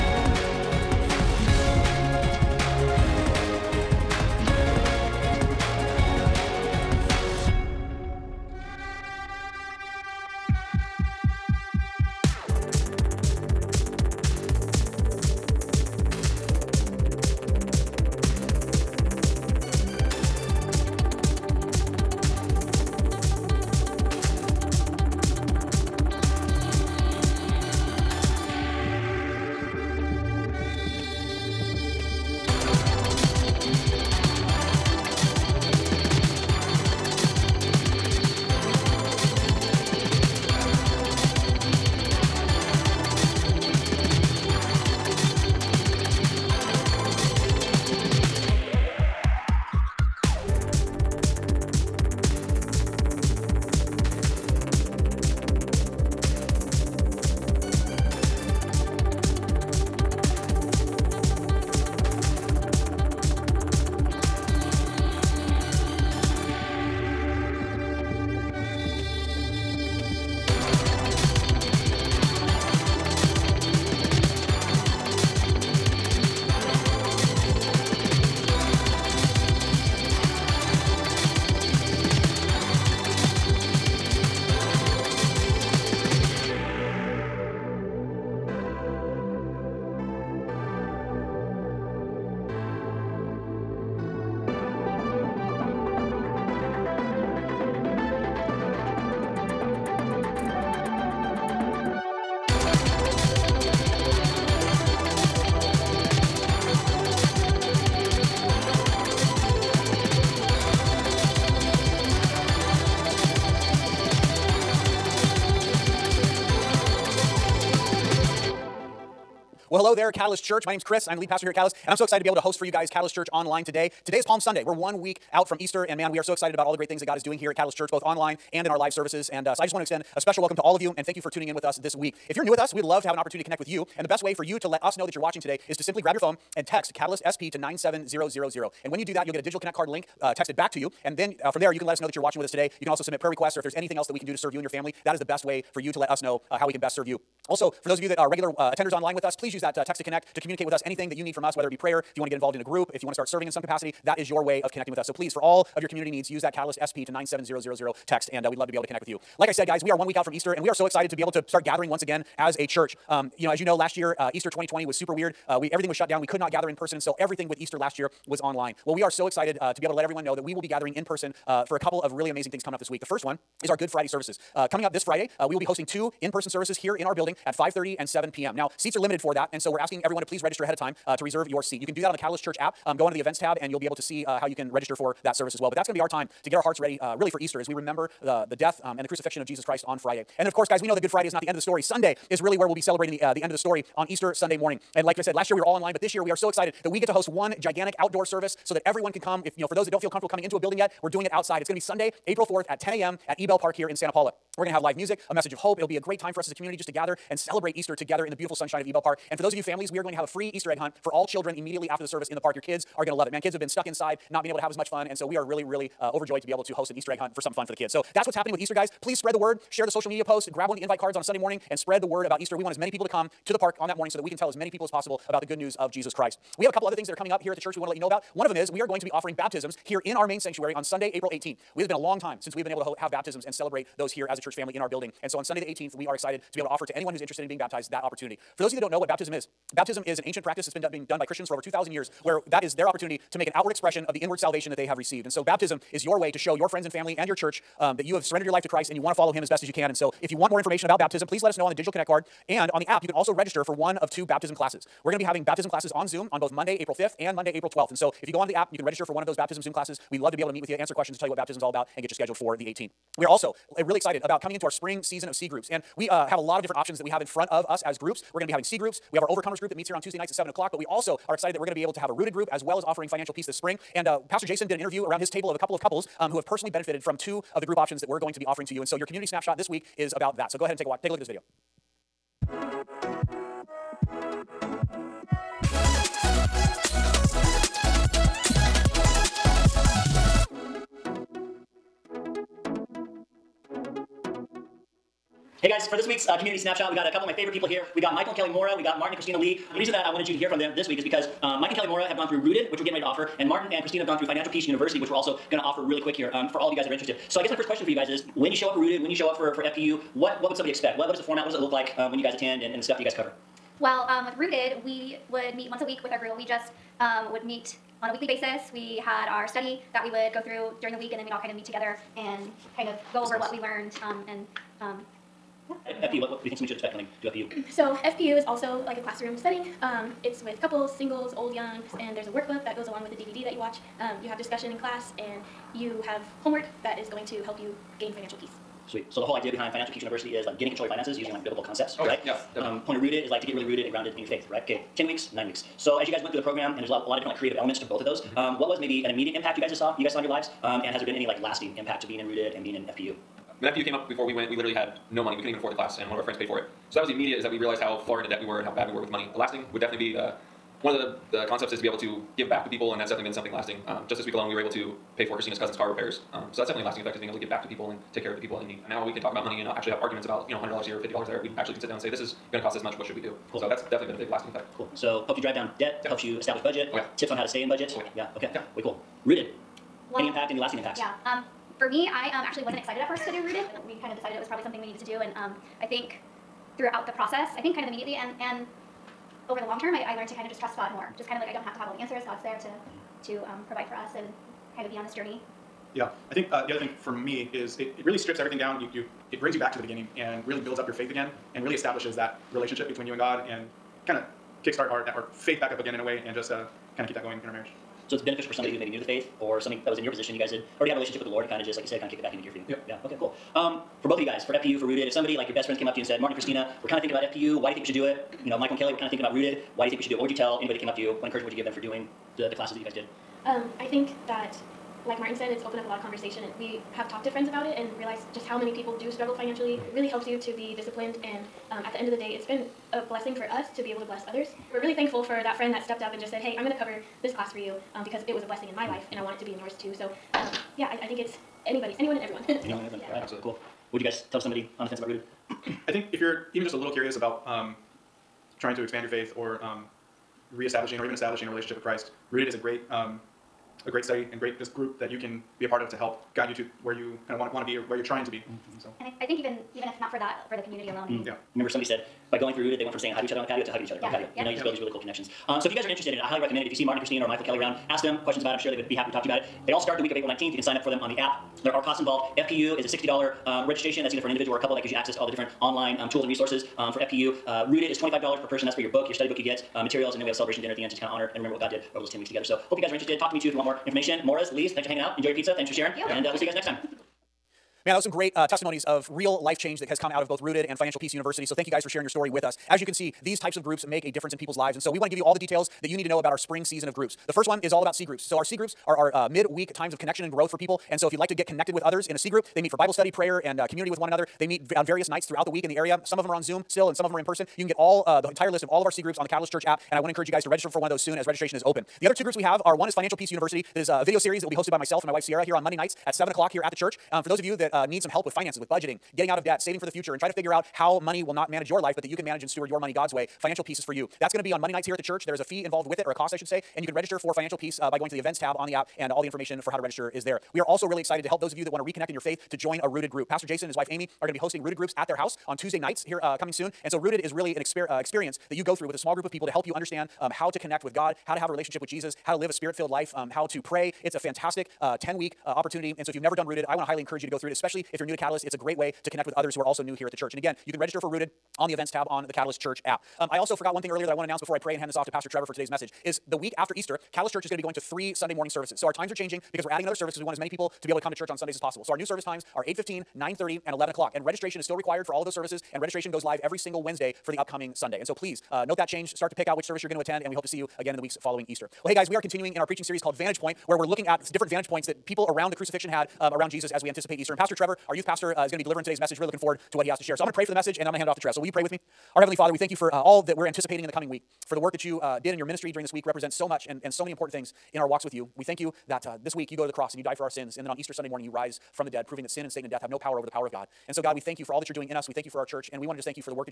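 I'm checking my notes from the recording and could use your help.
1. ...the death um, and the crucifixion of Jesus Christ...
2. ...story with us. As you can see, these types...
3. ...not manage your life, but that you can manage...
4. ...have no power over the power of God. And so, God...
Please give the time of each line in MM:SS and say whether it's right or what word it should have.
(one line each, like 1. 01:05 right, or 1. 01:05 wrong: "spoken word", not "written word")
1. 03:08 right
2. 08:12 right
3. 08:41 right
4. 09:52 right.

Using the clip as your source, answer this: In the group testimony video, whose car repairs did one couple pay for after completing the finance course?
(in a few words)
Christina's cousin's.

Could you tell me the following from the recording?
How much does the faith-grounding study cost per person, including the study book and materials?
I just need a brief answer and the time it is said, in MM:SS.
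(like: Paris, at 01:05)
$25, at 07:57.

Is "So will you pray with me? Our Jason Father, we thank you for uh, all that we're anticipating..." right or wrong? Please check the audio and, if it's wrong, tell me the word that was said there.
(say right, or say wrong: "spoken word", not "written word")
wrong: "Heavenly", not "Jason".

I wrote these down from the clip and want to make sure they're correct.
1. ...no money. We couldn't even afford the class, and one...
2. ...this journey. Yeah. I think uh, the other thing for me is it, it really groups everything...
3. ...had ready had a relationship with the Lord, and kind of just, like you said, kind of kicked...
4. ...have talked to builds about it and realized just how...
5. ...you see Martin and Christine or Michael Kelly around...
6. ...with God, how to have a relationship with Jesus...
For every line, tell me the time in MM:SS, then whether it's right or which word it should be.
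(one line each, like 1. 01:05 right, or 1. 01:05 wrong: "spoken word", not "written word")
1. 05:55 right
2. 06:35 wrong: "strips", not "groups"
3. 06:50 wrong: "already", not "ready"
4. 07:06 wrong: "friends", not "builds"
5. 07:46 right
6. 09:00 right.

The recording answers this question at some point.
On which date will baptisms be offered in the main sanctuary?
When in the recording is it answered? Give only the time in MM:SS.
03:50.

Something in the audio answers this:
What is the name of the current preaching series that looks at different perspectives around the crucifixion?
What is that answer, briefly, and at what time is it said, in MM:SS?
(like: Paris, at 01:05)
Vantage Point, at 09:33.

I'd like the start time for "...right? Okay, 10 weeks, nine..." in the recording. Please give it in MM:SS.
05:44.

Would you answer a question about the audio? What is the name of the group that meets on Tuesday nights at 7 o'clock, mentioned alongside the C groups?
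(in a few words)
Overcomers.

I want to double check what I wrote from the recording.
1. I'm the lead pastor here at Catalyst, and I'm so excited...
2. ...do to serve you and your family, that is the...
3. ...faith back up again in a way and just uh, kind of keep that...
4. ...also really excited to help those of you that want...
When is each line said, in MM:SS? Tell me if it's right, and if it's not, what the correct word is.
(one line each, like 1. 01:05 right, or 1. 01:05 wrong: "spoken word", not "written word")
1. 02:01 right
2. 02:24 right
3. 06:45 right
4. 08:50 right.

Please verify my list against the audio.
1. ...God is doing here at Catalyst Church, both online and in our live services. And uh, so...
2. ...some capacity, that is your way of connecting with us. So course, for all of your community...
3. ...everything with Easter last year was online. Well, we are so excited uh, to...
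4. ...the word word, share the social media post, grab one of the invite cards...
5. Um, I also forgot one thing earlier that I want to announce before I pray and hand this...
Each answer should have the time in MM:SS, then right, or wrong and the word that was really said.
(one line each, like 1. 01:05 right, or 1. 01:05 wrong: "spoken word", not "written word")
1. 02:07 right
2. 02:33 wrong: "please", not "course"
3. 02:47 right
4. 03:39 right
5. 09:13 right.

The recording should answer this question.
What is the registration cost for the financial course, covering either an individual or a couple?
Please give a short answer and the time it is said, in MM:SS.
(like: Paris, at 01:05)
$60, at 07:52.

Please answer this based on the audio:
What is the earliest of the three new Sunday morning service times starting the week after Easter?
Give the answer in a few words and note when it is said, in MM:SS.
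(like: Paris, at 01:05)
8:15, at 09:22.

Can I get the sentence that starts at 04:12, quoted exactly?
And on the app, you can also register for one of two baptism classes.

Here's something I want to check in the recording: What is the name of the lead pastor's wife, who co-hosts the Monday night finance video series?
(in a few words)
Sierra.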